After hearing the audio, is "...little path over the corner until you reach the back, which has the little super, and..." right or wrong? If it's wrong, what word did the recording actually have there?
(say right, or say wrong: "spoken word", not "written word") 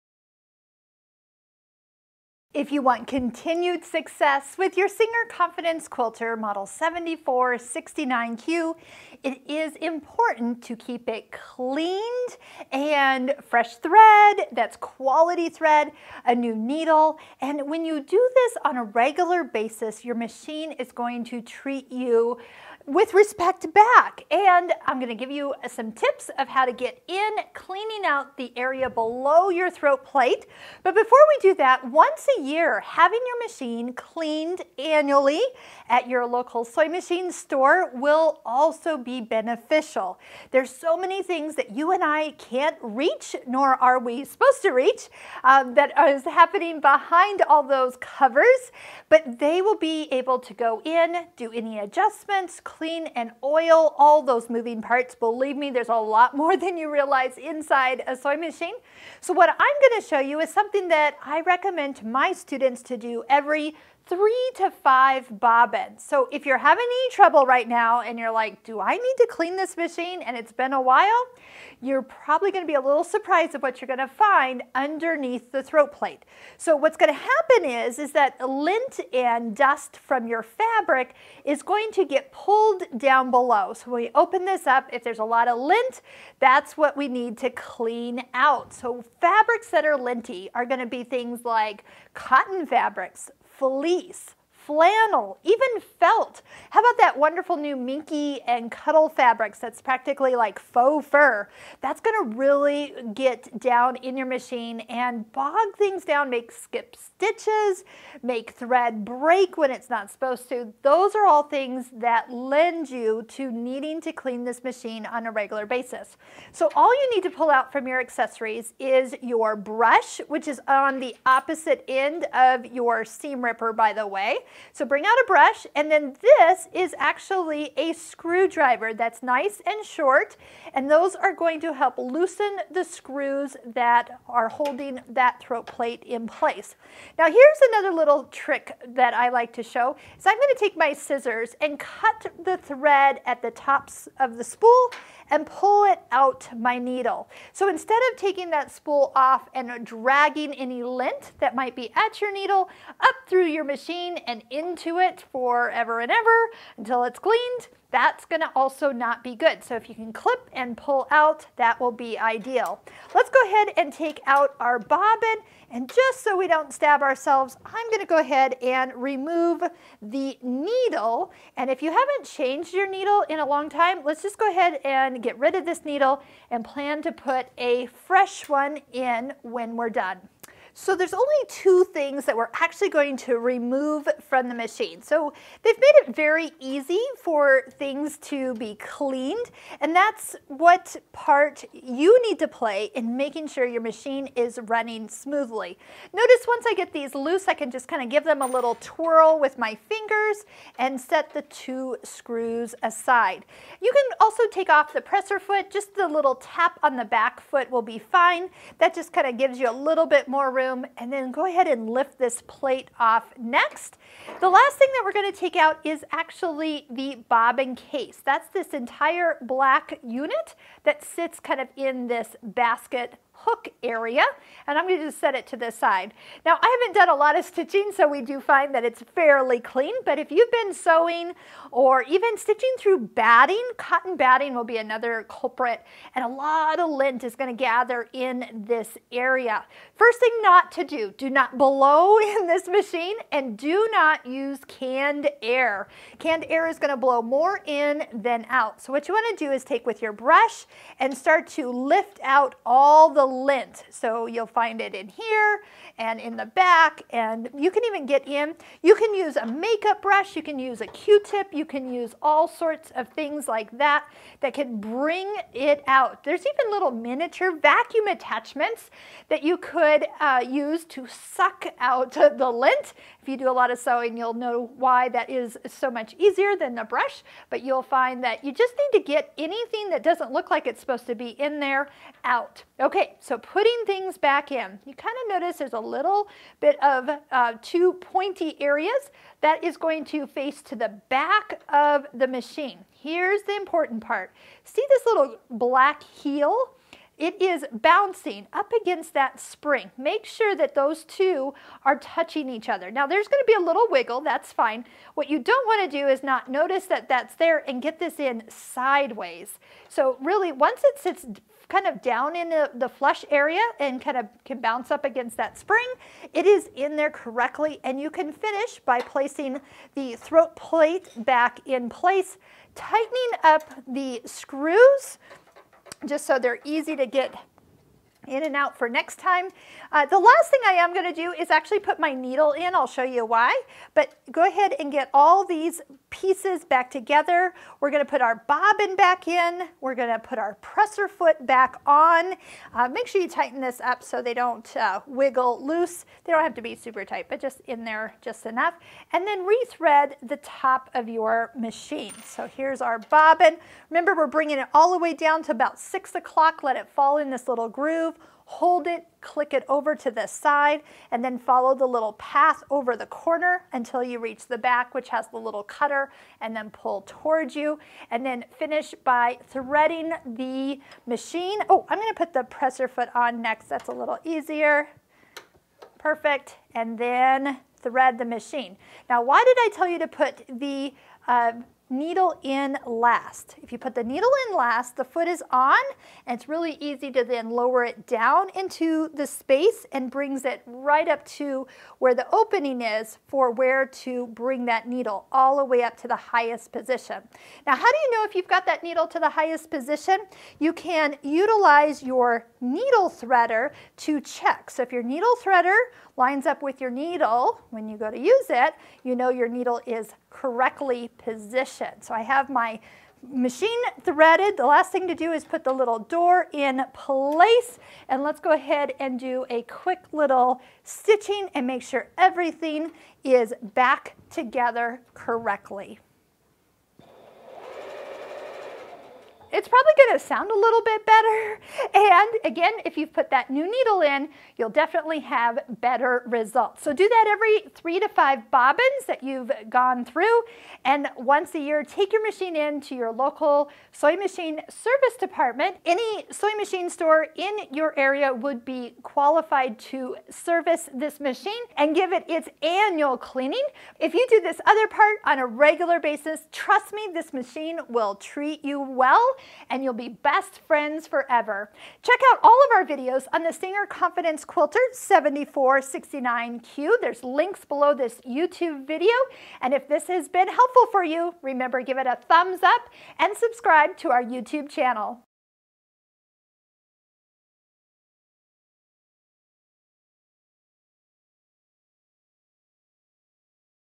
wrong: "cutter", not "super".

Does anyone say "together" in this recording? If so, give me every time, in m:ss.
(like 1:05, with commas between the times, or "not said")
5:36, 7:04.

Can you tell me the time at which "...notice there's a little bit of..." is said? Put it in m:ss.
4:45.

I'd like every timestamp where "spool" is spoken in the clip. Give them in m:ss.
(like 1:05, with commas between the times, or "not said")
2:24, 2:28.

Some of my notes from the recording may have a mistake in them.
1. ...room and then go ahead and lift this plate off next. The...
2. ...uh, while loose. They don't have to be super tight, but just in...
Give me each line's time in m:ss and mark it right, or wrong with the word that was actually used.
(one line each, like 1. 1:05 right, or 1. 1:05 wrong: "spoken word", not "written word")
1. 3:30 right
2. 5:44 wrong: "wiggle", not "while".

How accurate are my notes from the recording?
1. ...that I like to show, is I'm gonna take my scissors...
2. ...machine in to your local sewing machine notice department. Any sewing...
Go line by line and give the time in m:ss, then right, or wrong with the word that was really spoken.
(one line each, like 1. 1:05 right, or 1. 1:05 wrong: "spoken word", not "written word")
1. 2:18 right
2. 7:22 wrong: "service", not "notice".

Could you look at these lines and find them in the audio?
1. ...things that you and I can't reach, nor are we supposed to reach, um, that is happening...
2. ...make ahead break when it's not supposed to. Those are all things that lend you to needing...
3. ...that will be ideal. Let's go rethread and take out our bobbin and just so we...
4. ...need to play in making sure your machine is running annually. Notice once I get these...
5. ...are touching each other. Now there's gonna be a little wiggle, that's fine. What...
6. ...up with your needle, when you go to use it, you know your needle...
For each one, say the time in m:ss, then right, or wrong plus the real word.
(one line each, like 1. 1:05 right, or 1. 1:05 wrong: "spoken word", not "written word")
1. 0:41 right
2. 1:48 wrong: "thread", not "ahead"
3. 2:41 wrong: "ahead", not "rethread"
4. 3:12 wrong: "smoothly", not "annually"
5. 5:01 right
6. 6:46 right.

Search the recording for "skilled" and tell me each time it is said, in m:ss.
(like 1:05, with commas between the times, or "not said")
not said.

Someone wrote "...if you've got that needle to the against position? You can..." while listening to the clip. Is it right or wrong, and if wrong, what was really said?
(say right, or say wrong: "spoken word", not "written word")
wrong: "highest", not "against".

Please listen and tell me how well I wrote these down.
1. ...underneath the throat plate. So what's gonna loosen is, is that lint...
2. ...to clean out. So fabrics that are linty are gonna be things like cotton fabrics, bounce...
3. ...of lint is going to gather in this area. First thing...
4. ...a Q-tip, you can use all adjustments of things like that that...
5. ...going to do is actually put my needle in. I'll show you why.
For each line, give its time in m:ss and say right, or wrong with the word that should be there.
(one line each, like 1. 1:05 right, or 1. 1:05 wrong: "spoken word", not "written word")
1. 1:14 wrong: "happen", not "loosen"
2. 1:27 wrong: "fleece", not "bounce"
3. 3:56 right
4. 4:20 wrong: "sorts", not "adjustments"
5. 5:30 right.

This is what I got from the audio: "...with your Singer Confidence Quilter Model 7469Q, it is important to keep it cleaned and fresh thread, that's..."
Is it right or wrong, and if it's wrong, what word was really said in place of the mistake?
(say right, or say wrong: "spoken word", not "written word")
right.